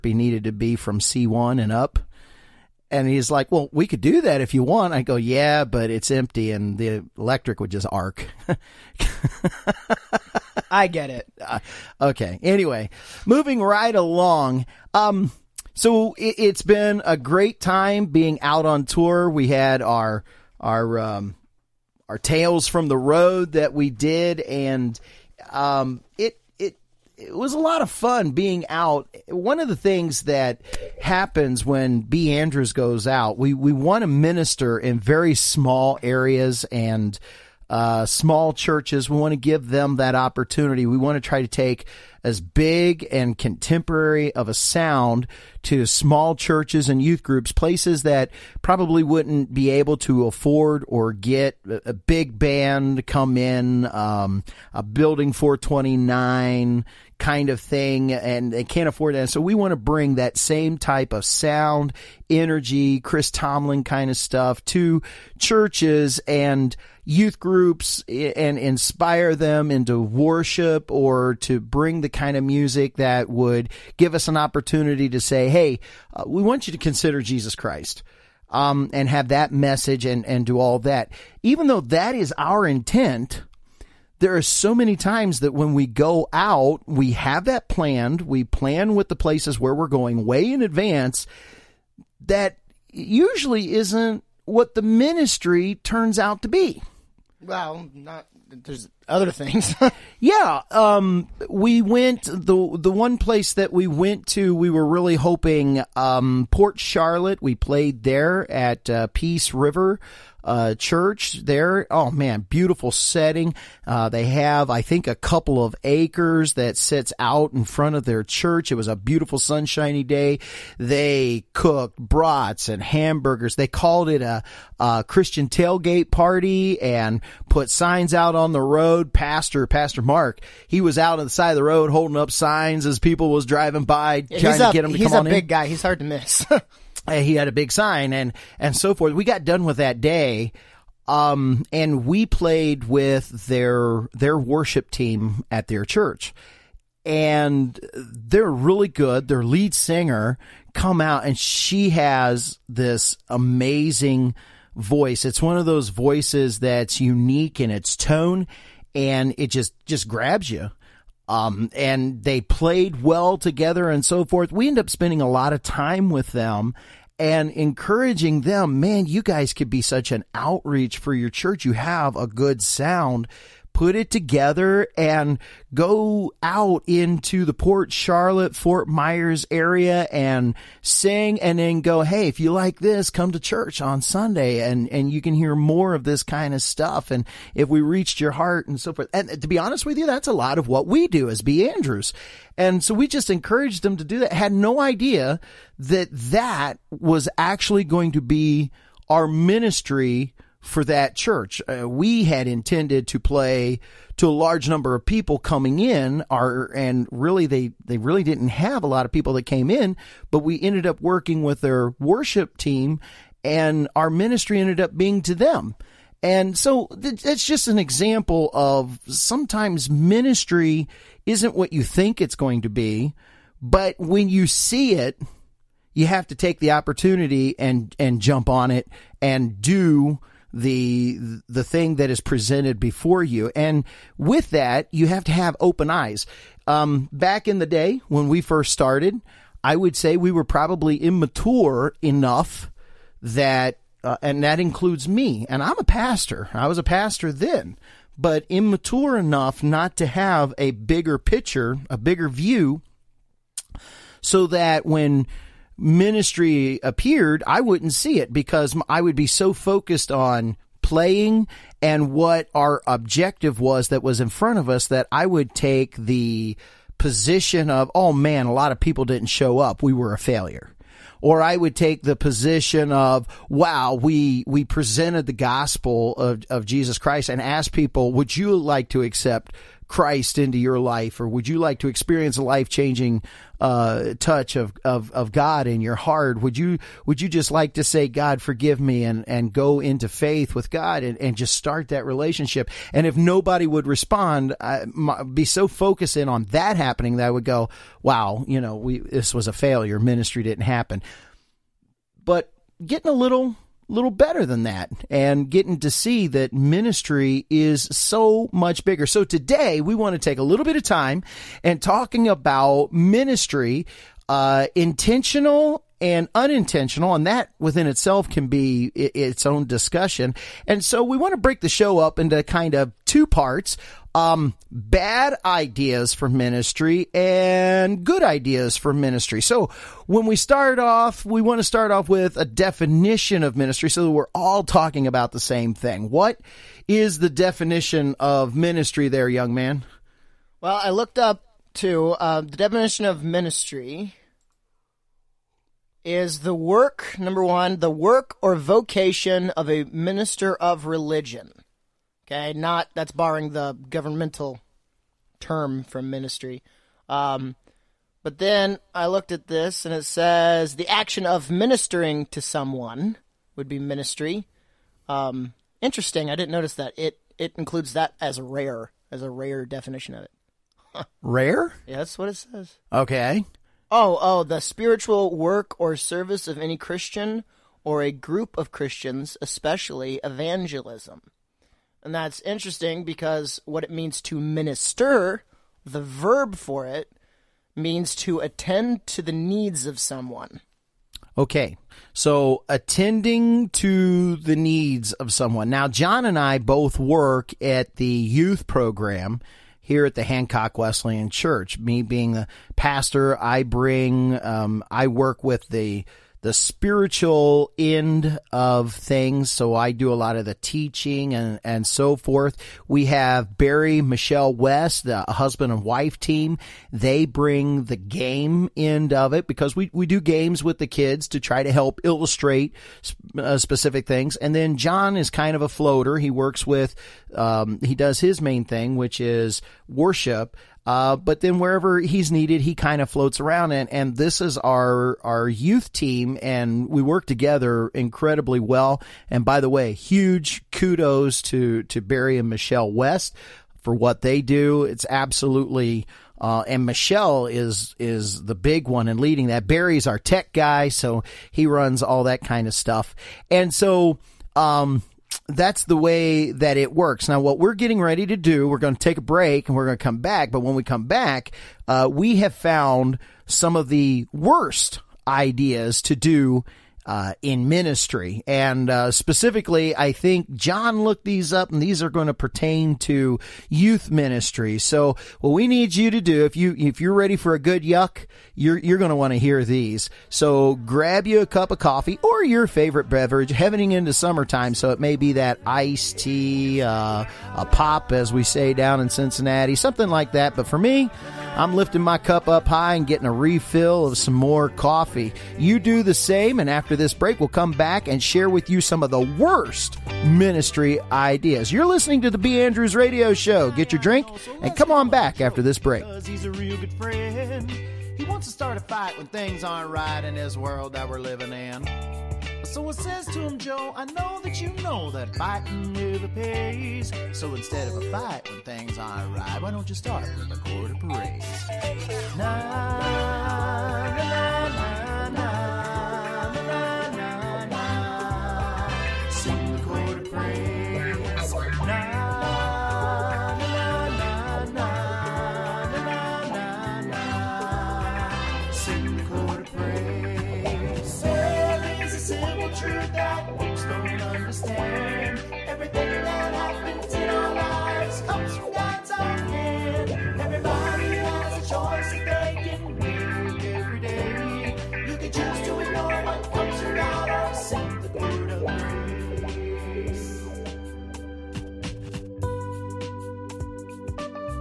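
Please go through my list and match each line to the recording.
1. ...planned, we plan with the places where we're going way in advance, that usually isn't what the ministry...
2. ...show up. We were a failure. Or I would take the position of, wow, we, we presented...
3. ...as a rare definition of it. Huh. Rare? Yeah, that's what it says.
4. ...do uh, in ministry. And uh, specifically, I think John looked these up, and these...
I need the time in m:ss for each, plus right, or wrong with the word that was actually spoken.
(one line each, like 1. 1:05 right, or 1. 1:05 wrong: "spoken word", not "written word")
1. 1:27 right
2. 4:29 right
3. 6:09 right
4. 7:46 right.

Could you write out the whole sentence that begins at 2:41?
Um, and they played well together and so forth.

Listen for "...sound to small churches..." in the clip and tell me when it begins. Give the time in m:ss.
0:44.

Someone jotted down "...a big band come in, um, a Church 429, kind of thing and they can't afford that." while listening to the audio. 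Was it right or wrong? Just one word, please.
wrong.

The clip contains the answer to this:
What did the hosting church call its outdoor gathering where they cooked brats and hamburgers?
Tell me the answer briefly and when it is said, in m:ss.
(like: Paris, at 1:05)
Christian tailgate party, at 2:05.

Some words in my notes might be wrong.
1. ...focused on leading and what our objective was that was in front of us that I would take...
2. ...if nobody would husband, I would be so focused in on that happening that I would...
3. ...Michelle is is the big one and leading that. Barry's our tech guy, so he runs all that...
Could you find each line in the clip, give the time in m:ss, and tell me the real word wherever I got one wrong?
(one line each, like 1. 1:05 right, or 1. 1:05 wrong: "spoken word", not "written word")
1. 4:19 wrong: "playing", not "leading"
2. 4:53 wrong: "respond", not "husband"
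3. 7:26 right.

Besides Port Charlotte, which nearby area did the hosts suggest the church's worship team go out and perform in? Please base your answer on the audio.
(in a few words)
Fort Myers.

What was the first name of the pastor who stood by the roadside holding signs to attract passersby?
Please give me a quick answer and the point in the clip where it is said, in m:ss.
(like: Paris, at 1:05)
Mark, at 2:09.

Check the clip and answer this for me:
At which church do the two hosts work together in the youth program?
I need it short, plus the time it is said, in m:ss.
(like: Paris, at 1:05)
Hancock Wesleyan Church, at 6:40.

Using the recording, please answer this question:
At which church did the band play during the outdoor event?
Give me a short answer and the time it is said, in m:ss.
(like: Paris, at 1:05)
Peace River, at 1:49.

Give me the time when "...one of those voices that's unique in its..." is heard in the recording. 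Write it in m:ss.
2:35.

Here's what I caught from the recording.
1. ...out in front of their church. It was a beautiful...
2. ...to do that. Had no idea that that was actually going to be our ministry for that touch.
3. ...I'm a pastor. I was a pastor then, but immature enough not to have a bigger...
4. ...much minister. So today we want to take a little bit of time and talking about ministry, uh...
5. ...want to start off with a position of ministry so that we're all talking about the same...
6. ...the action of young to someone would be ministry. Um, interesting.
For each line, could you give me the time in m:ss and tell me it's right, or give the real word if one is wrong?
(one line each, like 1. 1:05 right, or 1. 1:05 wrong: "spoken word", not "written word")
1. 1:57 right
2. 3:13 wrong: "church", not "touch"
3. 4:05 right
4. 5:08 wrong: "bigger", not "minister"
5. 5:31 wrong: "definition", not "position"
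6. 6:00 wrong: "ministering", not "young".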